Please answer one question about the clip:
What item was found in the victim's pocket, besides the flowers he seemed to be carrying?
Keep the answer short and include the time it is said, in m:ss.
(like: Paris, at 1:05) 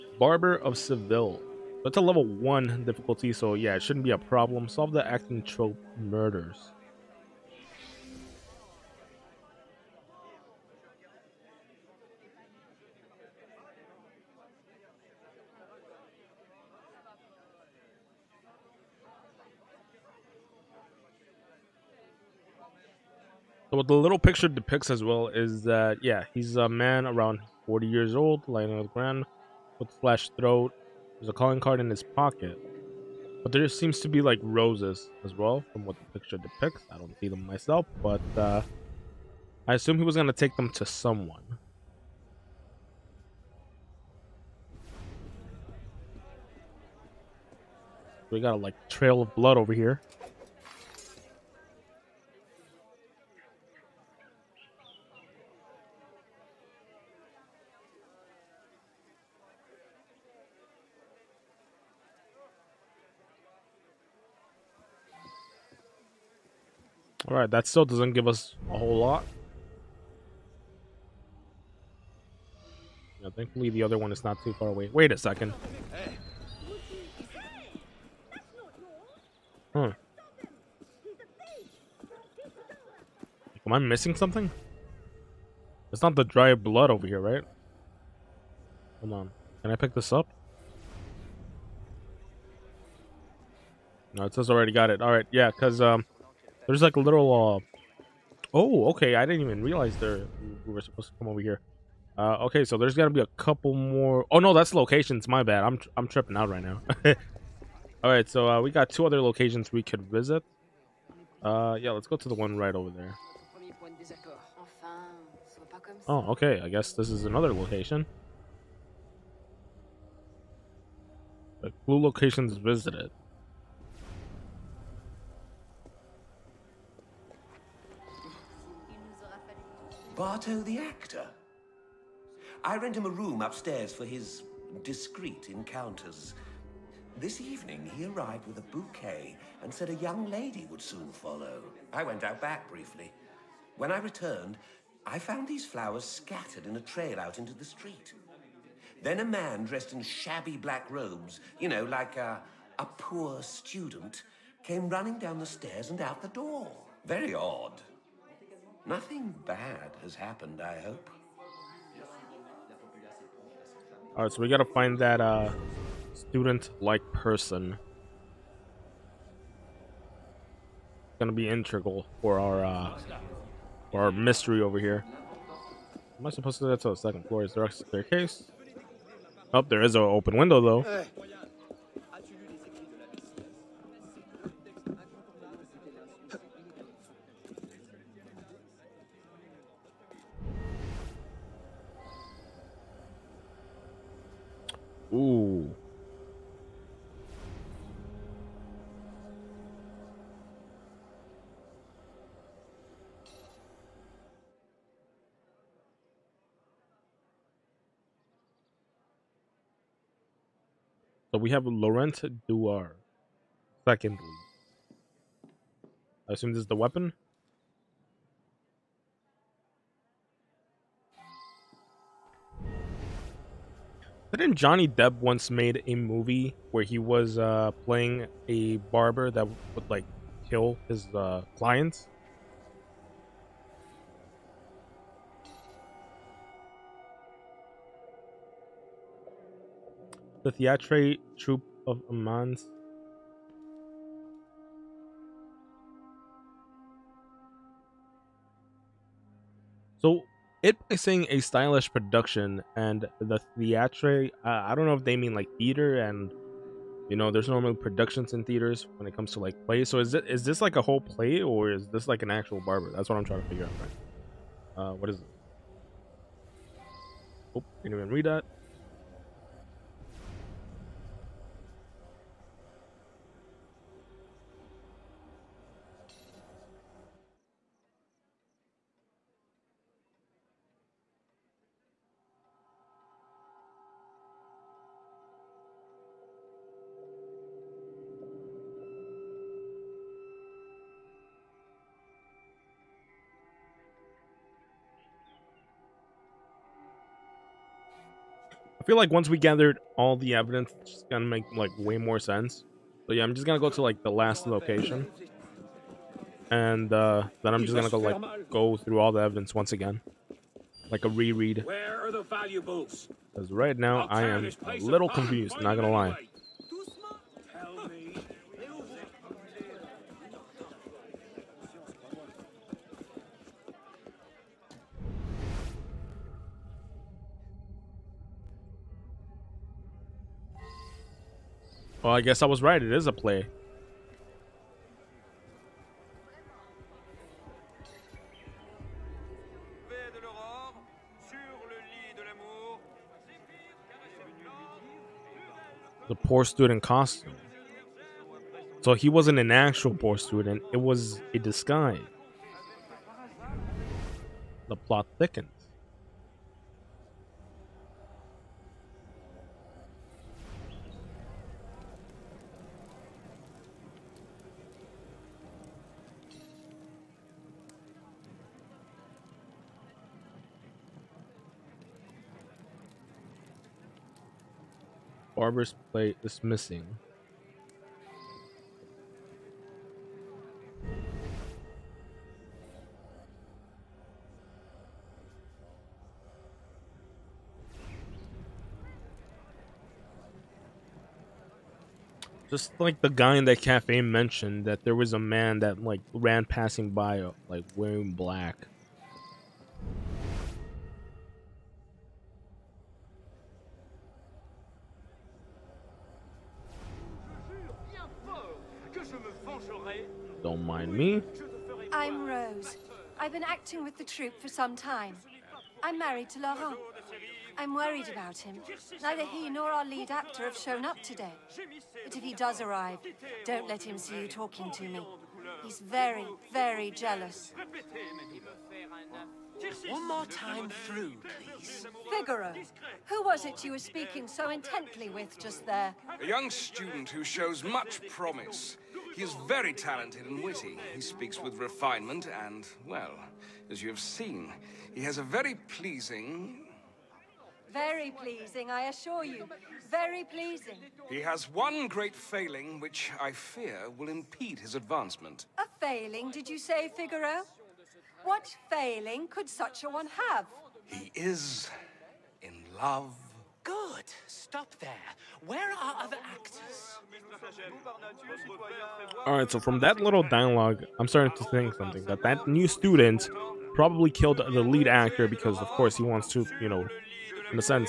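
A calling card, at 0:31.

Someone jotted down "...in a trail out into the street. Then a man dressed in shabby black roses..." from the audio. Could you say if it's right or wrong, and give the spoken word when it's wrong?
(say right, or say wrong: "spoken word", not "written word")
wrong: "robes", not "roses".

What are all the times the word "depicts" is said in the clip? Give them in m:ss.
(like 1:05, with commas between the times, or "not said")
0:24, 0:36.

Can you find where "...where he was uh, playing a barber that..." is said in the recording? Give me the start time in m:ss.
3:46.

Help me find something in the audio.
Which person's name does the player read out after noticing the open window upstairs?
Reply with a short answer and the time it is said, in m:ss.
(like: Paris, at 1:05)
Laurent Duar, at 3:31.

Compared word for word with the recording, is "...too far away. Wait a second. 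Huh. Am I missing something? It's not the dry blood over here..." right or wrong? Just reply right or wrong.
right.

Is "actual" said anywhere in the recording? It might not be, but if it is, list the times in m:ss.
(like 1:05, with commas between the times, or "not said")
4:22, 5:49.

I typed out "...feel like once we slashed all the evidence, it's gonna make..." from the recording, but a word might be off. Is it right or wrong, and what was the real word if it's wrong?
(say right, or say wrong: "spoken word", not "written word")
wrong: "gathered", not "slashed".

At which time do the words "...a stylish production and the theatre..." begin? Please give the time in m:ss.
4:11.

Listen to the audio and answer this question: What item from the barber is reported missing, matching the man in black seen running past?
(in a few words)
Barber's plate.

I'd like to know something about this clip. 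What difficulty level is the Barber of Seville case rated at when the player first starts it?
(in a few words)
Level 1.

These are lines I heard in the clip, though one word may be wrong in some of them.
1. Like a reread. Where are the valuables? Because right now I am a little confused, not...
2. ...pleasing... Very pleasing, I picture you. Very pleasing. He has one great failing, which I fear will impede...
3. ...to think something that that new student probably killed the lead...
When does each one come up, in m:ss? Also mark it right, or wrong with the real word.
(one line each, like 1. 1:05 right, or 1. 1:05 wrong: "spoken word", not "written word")
1. 5:10 right
2. 7:25 wrong: "assure", not "picture"
3. 7:51 right.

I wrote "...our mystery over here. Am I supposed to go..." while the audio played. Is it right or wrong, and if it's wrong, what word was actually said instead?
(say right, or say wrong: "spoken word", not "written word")
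right.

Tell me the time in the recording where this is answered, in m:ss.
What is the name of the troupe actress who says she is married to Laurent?
6:52.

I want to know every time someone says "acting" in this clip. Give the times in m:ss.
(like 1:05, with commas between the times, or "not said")
0:05, 6:53.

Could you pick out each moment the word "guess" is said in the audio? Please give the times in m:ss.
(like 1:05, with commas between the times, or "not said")
1:56, 5:32.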